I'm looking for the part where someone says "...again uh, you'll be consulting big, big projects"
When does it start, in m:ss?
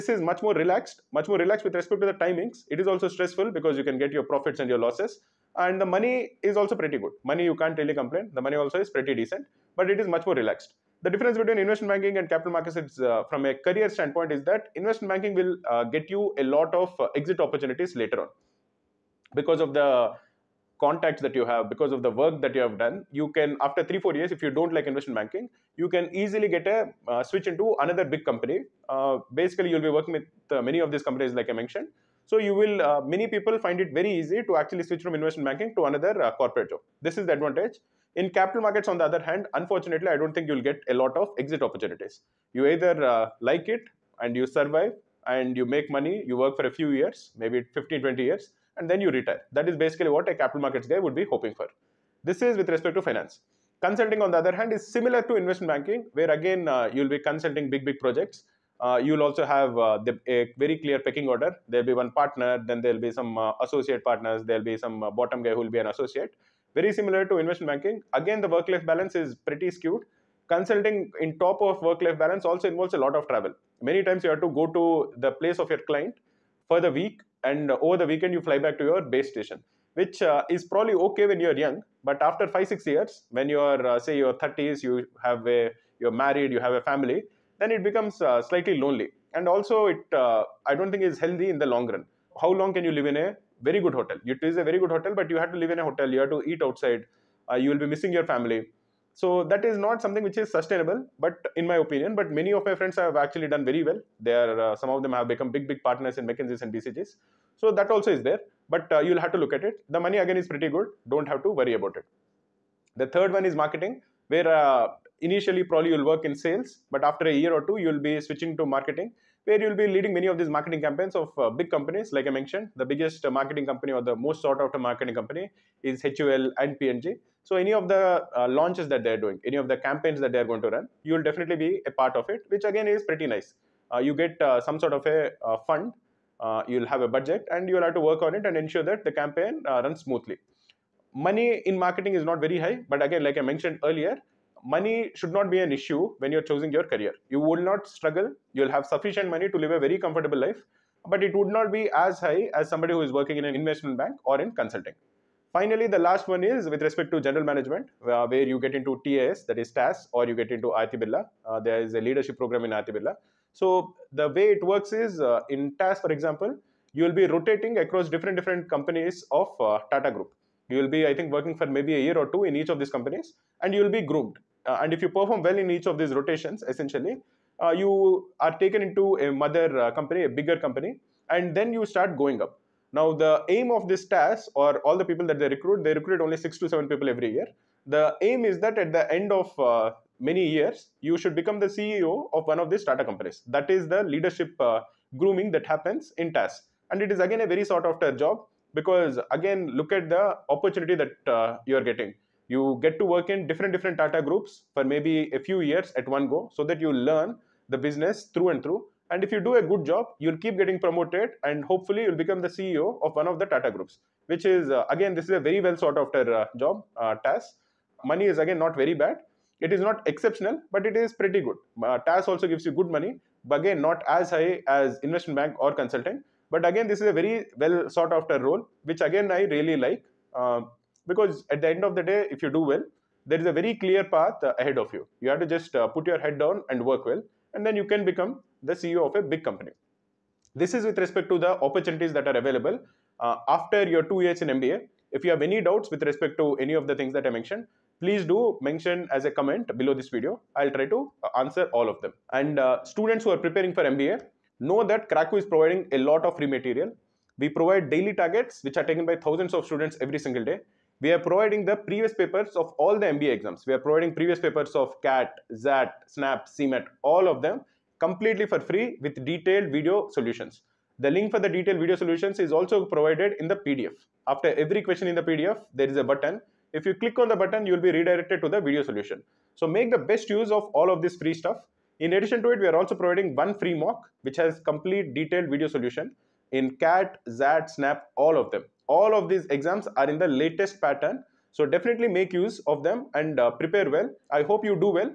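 0:56.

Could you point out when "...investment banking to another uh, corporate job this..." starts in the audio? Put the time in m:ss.
0:35.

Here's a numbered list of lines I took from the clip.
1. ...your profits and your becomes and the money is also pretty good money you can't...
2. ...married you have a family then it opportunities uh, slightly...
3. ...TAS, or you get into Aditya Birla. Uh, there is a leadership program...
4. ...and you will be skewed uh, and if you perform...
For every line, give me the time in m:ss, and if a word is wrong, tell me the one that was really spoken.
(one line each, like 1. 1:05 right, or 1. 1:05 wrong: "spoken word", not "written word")
1. 0:04 wrong: "losses", not "becomes"
2. 1:26 wrong: "becomes", not "opportunities"
3. 2:39 right
4. 2:53 wrong: "groomed", not "skewed".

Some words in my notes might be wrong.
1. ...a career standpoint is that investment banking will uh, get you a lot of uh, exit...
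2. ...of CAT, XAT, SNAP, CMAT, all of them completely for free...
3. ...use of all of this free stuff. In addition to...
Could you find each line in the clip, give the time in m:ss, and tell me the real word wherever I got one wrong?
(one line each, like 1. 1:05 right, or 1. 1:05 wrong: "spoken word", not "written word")
1. 0:13 right
2. 4:24 right
3. 4:40 right.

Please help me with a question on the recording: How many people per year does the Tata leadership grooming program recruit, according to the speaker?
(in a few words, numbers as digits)
6 to 7.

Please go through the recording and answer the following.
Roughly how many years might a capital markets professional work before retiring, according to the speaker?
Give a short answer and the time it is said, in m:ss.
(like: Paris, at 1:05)
15-20 years, at 0:47.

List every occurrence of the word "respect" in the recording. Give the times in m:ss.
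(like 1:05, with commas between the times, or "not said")
0:01, 0:52, 2:36, 4:01, 4:06.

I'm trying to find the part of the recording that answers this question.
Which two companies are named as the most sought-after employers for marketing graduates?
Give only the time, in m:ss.
2:06.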